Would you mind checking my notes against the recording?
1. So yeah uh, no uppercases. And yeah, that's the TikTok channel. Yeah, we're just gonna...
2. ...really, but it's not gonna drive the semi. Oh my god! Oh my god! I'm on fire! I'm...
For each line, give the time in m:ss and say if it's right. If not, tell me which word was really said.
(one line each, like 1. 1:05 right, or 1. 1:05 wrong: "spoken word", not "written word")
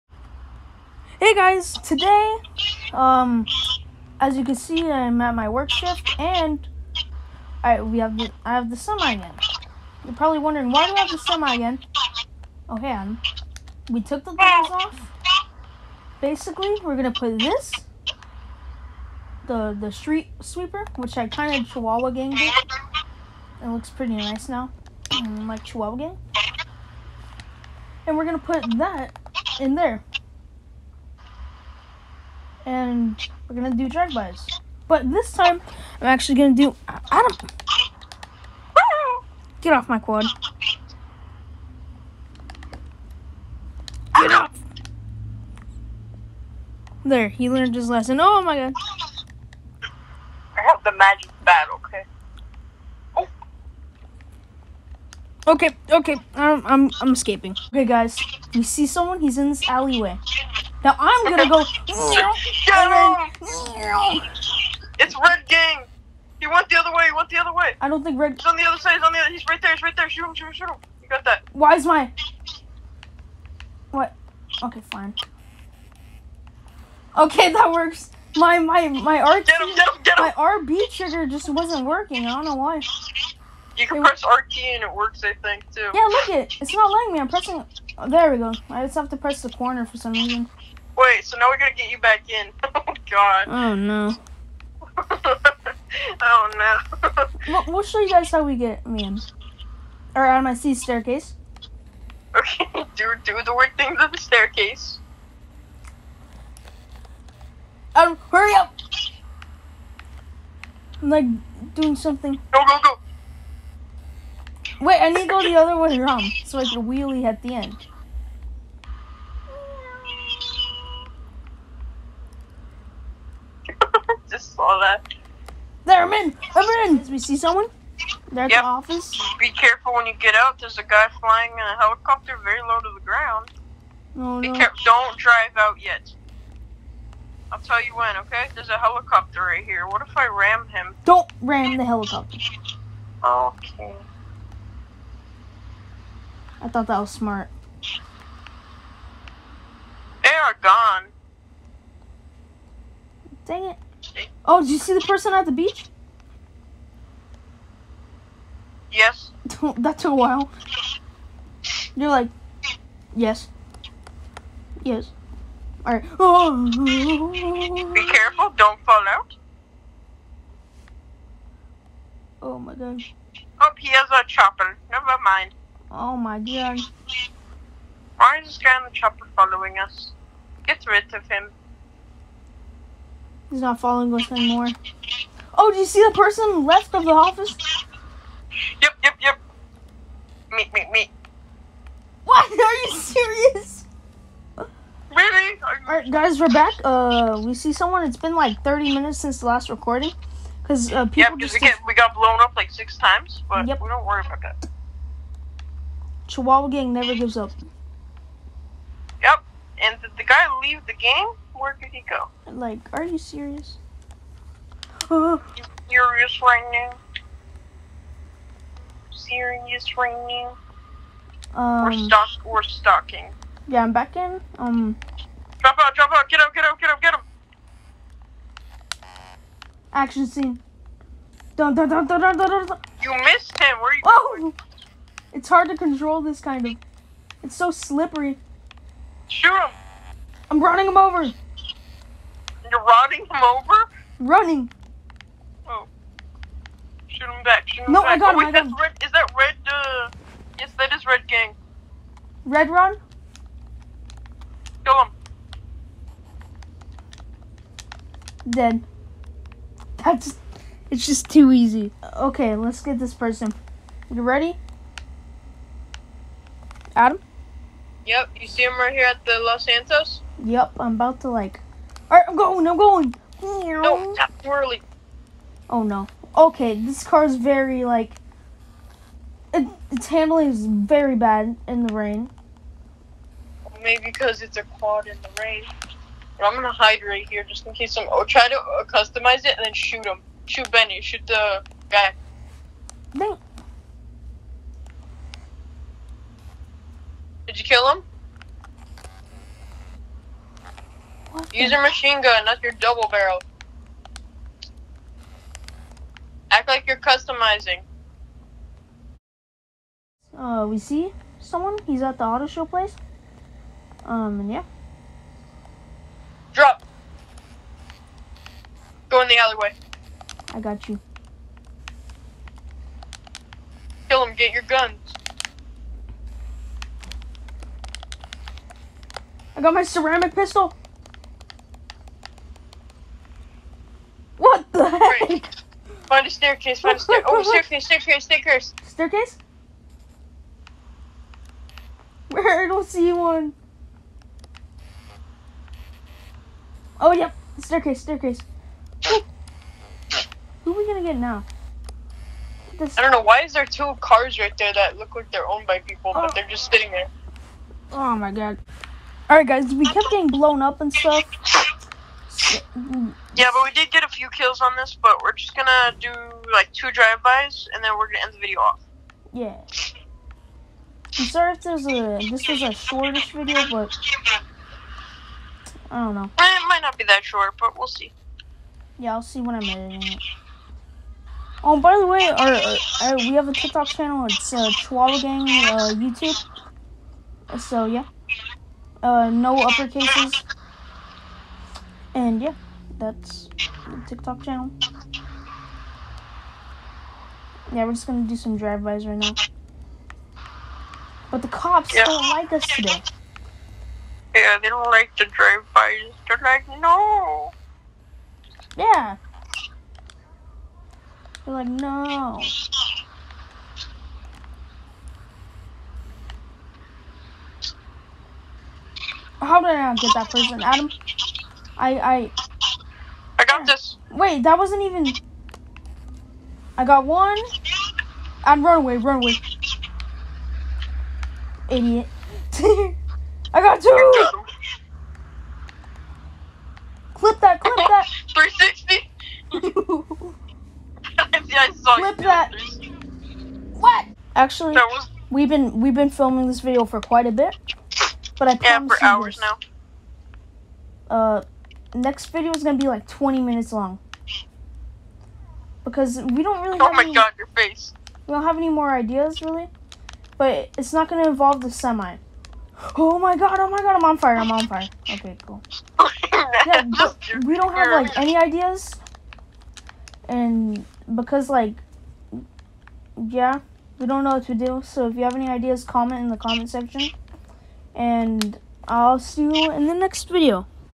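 1. 6:27 right
2. 7:39 wrong: "involve", not "drive".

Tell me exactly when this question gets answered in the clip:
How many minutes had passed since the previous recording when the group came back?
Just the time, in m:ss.
3:18.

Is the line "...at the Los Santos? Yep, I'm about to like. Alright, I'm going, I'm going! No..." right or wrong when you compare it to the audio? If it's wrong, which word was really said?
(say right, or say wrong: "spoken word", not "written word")
right.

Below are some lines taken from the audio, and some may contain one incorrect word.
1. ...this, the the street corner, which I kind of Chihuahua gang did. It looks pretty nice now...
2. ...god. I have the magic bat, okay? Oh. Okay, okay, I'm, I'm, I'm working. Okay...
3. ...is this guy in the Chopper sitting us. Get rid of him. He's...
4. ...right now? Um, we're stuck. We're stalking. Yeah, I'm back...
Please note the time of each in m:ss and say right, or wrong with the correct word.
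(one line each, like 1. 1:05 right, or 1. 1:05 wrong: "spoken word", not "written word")
1. 0:17 wrong: "sweeper", not "corner"
2. 0:48 wrong: "escaping", not "working"
3. 2:58 wrong: "following", not "sitting"
4. 3:39 right.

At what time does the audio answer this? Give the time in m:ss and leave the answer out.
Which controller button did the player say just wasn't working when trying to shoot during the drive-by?
1:20.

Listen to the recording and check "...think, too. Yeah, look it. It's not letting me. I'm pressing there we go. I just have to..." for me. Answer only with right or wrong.
right.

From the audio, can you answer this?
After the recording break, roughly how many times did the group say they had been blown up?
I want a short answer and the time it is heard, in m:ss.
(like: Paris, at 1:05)
6, at 3:22.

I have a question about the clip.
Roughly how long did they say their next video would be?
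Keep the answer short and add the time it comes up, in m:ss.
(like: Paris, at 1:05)
20 minutes, at 7:33.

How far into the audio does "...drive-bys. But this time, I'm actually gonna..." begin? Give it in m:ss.
0:33.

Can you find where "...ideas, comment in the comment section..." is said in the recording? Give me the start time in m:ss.
7:55.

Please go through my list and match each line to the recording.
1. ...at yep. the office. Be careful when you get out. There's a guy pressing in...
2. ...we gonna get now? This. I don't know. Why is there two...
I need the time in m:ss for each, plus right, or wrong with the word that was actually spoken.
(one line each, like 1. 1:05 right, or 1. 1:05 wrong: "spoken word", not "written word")
1. 2:08 wrong: "flying", not "pressing"
2. 5:50 right.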